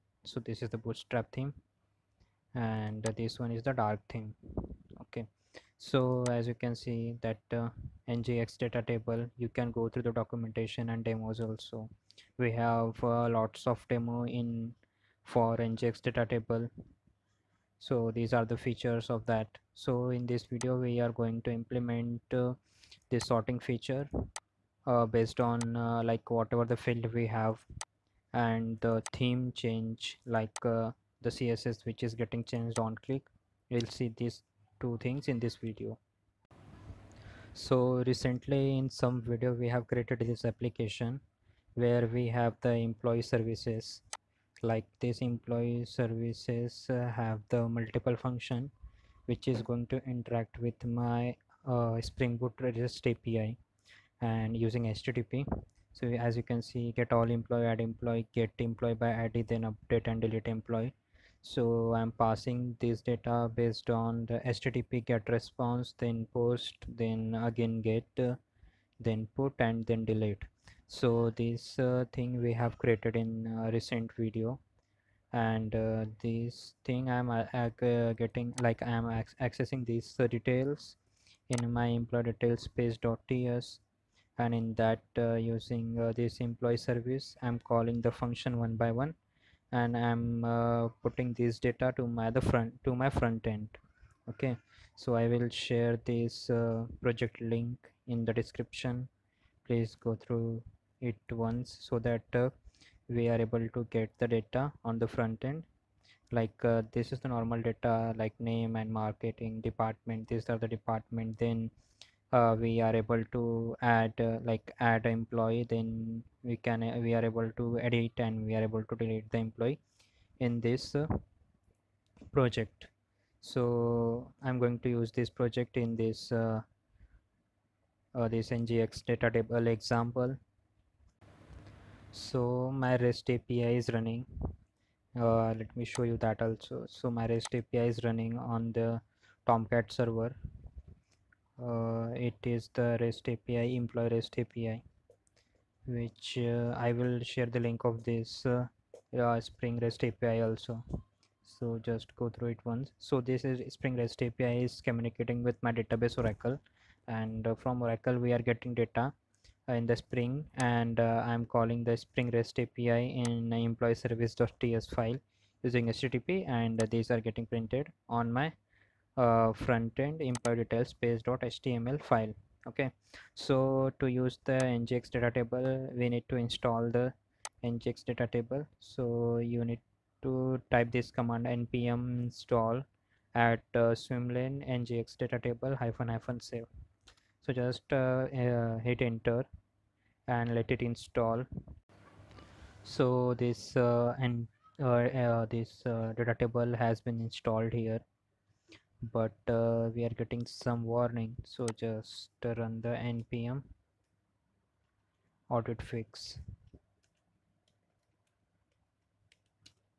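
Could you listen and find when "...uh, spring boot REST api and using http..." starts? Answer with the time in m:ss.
0:51.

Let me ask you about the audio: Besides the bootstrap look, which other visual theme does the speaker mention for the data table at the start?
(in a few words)
dark theme.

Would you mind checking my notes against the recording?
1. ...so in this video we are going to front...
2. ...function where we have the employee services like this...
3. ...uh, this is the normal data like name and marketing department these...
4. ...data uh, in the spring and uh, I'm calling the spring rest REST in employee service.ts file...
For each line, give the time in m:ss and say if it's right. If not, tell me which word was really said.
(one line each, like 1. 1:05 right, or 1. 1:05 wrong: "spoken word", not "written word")
1. 0:19 wrong: "implement", not "front"
2. 0:40 wrong: "application", not "function"
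3. 1:46 right
4. 2:38 wrong: "API", not "REST".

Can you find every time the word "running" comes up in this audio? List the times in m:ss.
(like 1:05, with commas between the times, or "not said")
2:13, 2:18.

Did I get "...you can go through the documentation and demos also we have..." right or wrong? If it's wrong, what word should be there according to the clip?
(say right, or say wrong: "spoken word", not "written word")
right.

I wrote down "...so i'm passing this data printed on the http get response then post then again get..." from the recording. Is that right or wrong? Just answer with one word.
wrong.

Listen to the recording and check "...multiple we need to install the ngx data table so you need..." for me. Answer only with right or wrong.
wrong.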